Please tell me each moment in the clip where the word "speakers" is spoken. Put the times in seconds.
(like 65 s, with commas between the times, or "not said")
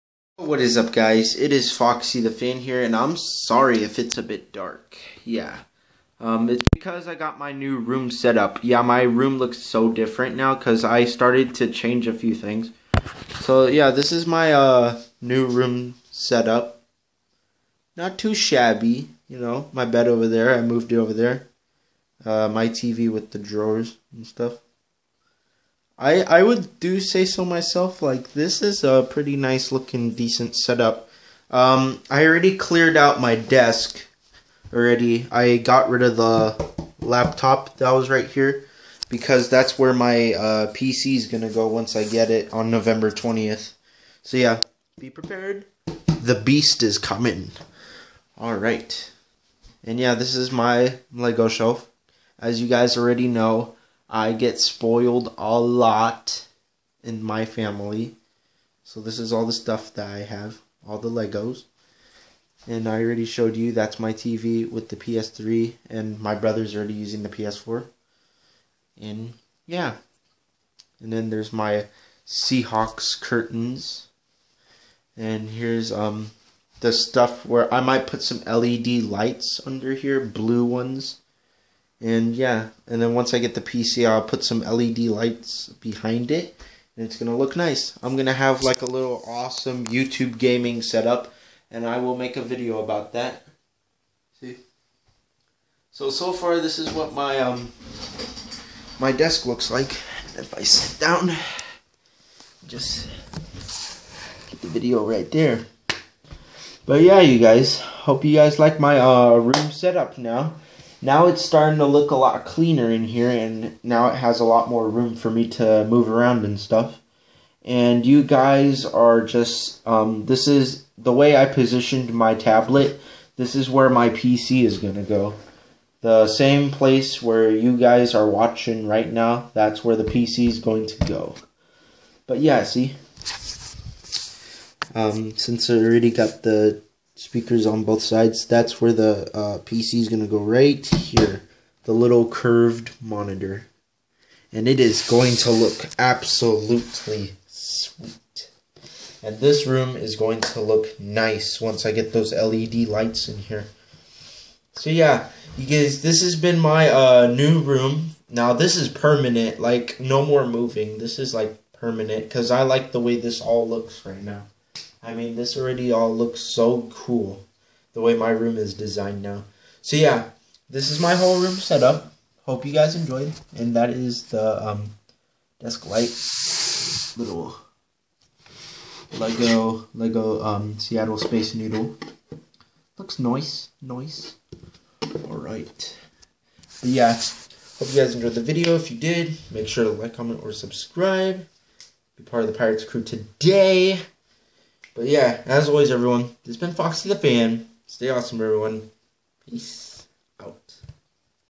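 137 s.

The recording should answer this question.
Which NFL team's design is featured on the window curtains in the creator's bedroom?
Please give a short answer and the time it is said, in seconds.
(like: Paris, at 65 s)
Seahawks, at 72 s.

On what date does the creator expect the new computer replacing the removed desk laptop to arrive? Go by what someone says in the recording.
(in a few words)
November 20.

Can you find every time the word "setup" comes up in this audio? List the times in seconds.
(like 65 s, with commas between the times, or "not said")
16 s, 30 s, 90 s, 109 s, 171 s.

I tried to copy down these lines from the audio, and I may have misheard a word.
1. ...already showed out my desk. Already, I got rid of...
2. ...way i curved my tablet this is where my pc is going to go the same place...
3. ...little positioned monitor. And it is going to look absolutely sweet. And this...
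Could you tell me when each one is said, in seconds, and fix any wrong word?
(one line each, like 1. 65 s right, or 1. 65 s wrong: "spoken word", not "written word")
1. 32 s wrong: "cleared", not "showed"
2. 121 s wrong: "positioned", not "curved"
3. 141 s wrong: "curved", not "positioned".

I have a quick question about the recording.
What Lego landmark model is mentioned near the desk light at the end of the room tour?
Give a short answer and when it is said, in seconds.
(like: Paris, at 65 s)
Seattle Space Needle, at 180 s.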